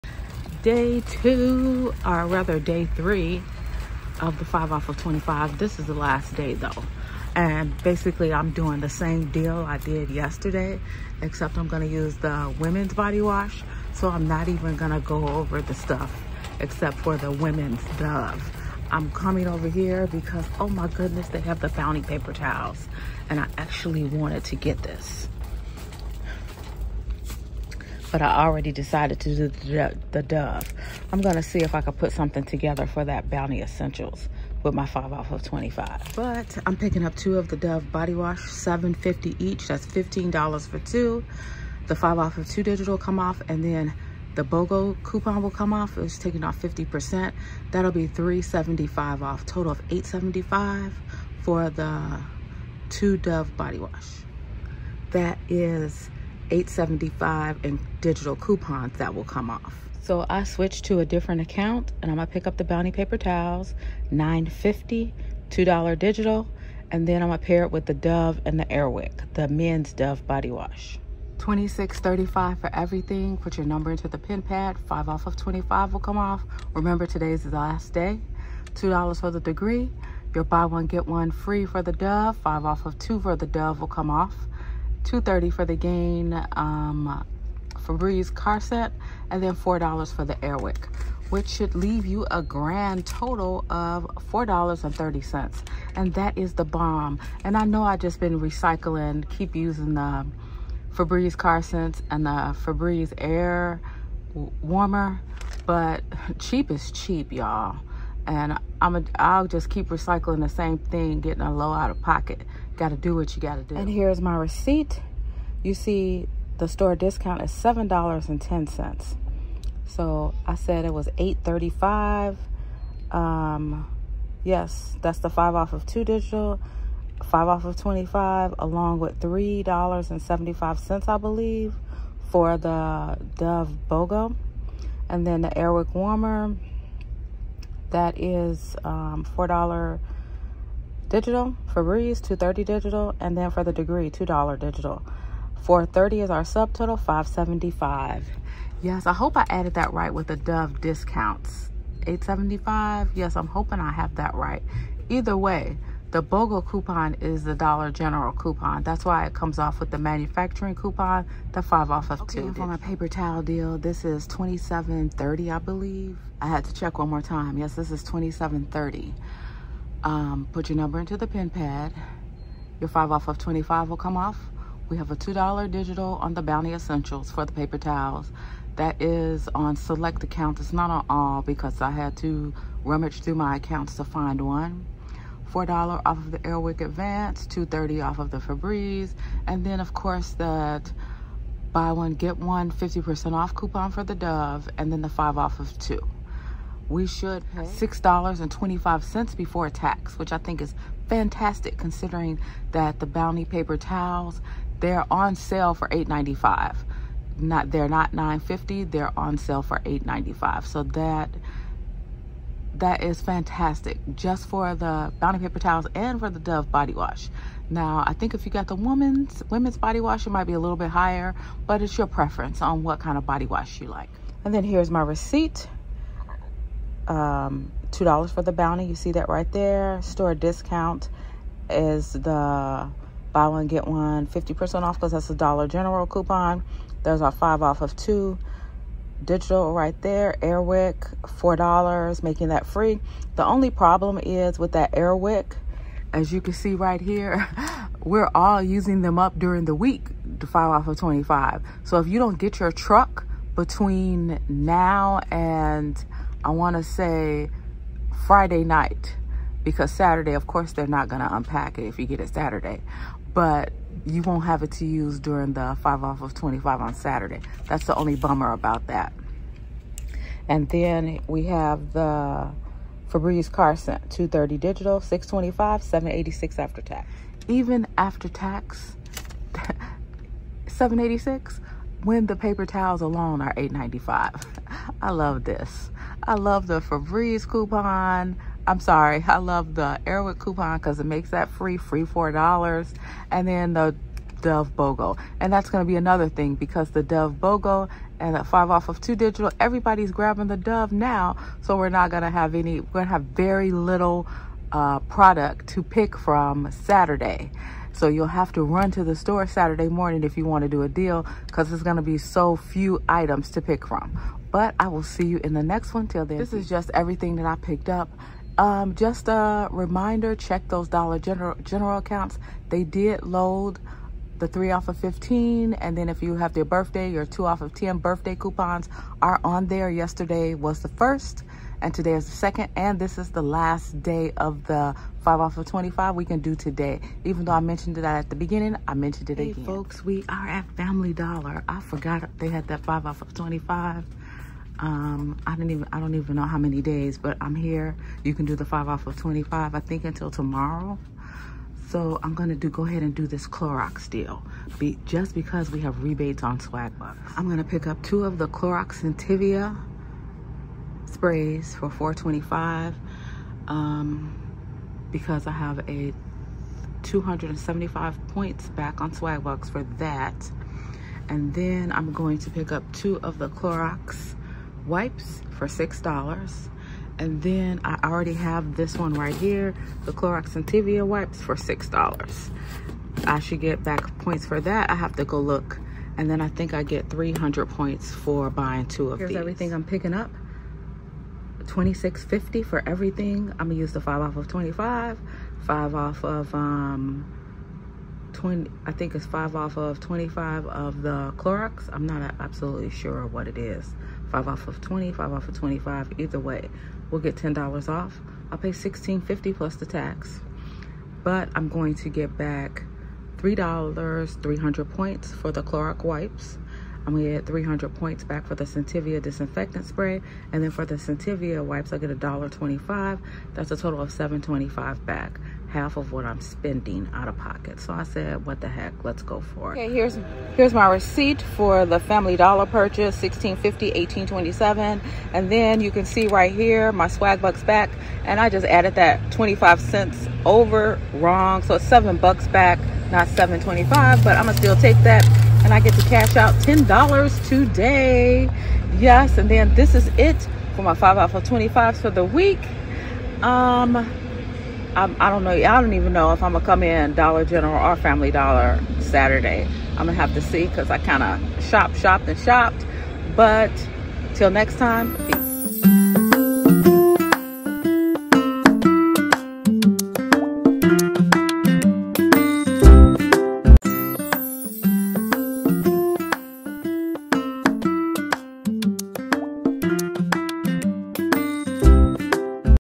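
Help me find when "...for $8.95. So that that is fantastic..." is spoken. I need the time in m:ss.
3:29.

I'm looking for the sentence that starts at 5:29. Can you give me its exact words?
Yesterday was the first and today is the second.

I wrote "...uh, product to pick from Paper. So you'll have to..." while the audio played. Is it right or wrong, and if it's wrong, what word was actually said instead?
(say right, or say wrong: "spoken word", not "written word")
wrong: "Saturday", not "Paper".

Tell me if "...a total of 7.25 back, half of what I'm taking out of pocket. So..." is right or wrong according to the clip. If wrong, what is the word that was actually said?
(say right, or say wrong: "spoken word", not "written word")
wrong: "spending", not "taking".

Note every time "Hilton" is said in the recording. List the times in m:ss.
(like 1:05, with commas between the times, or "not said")
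not said.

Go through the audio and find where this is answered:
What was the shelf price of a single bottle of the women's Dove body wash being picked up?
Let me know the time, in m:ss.
0:38.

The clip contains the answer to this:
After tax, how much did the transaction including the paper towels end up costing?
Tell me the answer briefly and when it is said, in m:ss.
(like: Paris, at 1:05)
$7.86, at 4:35.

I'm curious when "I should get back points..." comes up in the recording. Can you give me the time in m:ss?
6:23.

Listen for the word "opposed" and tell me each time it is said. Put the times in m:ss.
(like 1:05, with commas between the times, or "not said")
not said.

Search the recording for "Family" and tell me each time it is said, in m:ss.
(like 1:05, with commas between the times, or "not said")
5:40, 7:11, 7:37.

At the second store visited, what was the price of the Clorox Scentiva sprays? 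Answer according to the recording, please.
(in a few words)
$4.25.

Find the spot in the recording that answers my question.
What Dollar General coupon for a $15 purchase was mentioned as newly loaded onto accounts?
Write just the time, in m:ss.
5:24.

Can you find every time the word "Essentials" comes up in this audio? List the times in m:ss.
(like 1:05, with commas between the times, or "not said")
0:33, 2:56.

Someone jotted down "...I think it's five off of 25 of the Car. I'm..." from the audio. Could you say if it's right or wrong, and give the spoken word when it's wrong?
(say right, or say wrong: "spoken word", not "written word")
wrong: "Clorox", not "Car".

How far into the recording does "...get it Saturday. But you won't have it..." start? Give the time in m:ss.
4:22.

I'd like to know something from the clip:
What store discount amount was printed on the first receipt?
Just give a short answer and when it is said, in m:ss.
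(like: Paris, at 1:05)
$7.10, at 1:57.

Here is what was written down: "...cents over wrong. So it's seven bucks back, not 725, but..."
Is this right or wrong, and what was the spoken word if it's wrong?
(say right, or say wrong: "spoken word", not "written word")
right.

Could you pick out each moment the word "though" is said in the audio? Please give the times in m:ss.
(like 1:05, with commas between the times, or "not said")
0:06, 5:37.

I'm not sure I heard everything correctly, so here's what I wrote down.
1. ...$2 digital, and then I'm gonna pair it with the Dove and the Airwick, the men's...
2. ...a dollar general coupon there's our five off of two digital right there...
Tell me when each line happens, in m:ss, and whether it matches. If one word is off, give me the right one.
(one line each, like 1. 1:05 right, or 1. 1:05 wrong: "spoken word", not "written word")
1. 1:05 right
2. 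3:55 right.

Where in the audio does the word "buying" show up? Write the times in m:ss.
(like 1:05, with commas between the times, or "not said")
6:28.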